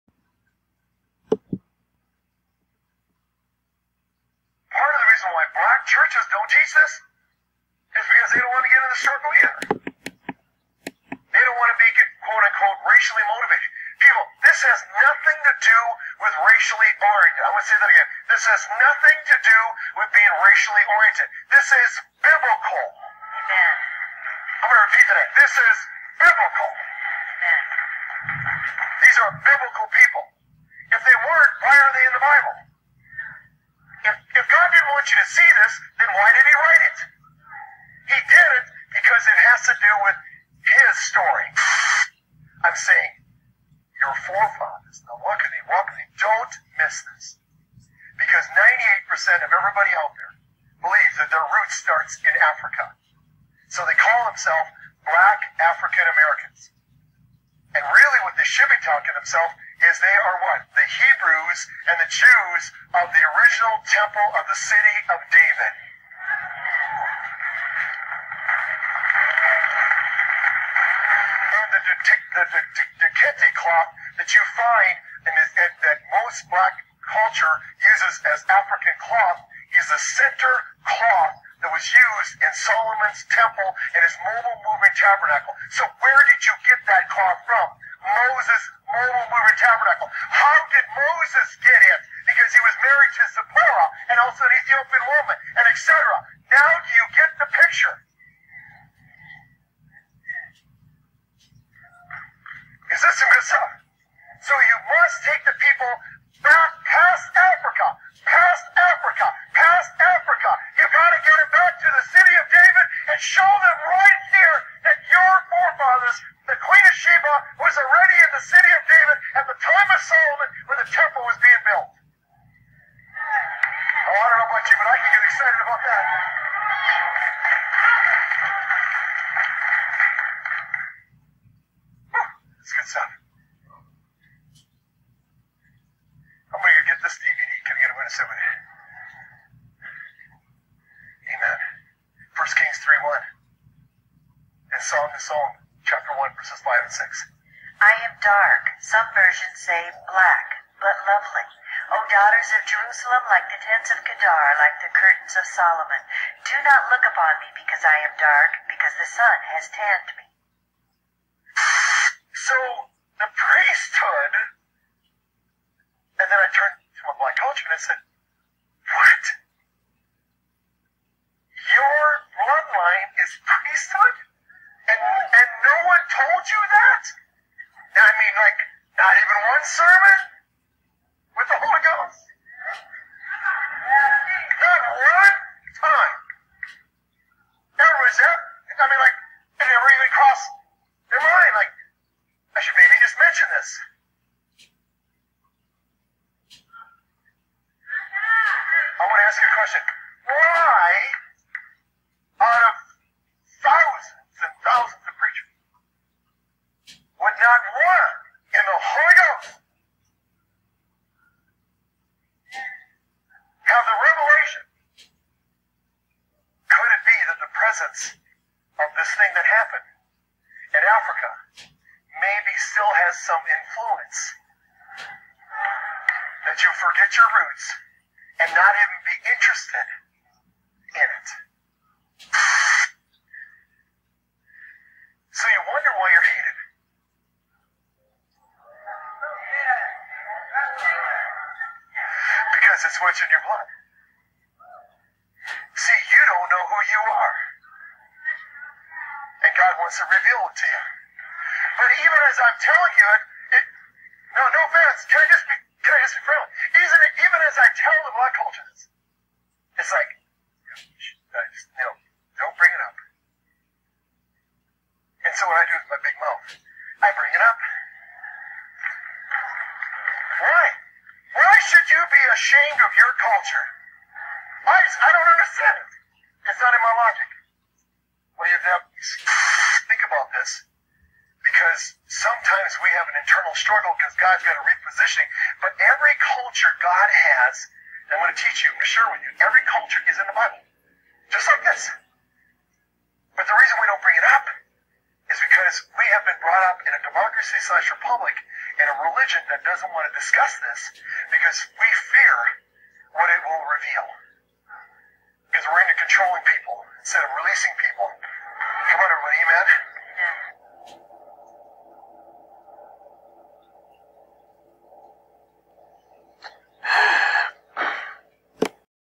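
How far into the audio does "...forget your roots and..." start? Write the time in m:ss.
3:46.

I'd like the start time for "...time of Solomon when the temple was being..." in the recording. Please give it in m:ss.
1:59.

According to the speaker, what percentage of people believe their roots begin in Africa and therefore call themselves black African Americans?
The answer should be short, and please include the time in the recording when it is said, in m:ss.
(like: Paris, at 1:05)
98%, at 0:48.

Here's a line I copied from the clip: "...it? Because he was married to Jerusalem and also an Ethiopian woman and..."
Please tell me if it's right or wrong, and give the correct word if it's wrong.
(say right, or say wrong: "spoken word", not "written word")
wrong: "Zipporah", not "Jerusalem".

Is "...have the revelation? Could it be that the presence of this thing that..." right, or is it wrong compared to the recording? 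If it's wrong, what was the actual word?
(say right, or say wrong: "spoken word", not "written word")
right.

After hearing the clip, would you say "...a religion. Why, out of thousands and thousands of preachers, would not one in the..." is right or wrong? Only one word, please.
wrong.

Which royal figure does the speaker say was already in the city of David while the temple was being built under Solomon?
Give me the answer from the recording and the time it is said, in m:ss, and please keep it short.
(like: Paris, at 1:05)
The Queen of Sheba, at 1:56.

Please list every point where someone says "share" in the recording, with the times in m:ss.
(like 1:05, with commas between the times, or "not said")
4:48.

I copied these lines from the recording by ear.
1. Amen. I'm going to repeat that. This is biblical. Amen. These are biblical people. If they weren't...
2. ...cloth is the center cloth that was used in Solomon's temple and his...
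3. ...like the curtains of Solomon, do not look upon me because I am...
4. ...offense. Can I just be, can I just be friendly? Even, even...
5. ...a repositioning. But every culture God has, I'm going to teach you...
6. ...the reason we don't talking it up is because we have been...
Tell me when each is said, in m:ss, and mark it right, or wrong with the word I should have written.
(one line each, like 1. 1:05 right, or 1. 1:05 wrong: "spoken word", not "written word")
1. 0:22 right
2. 1:19 right
3. 2:34 right
4. 4:14 right
5. 4:44 right
6. 4:53 wrong: "bring", not "talking".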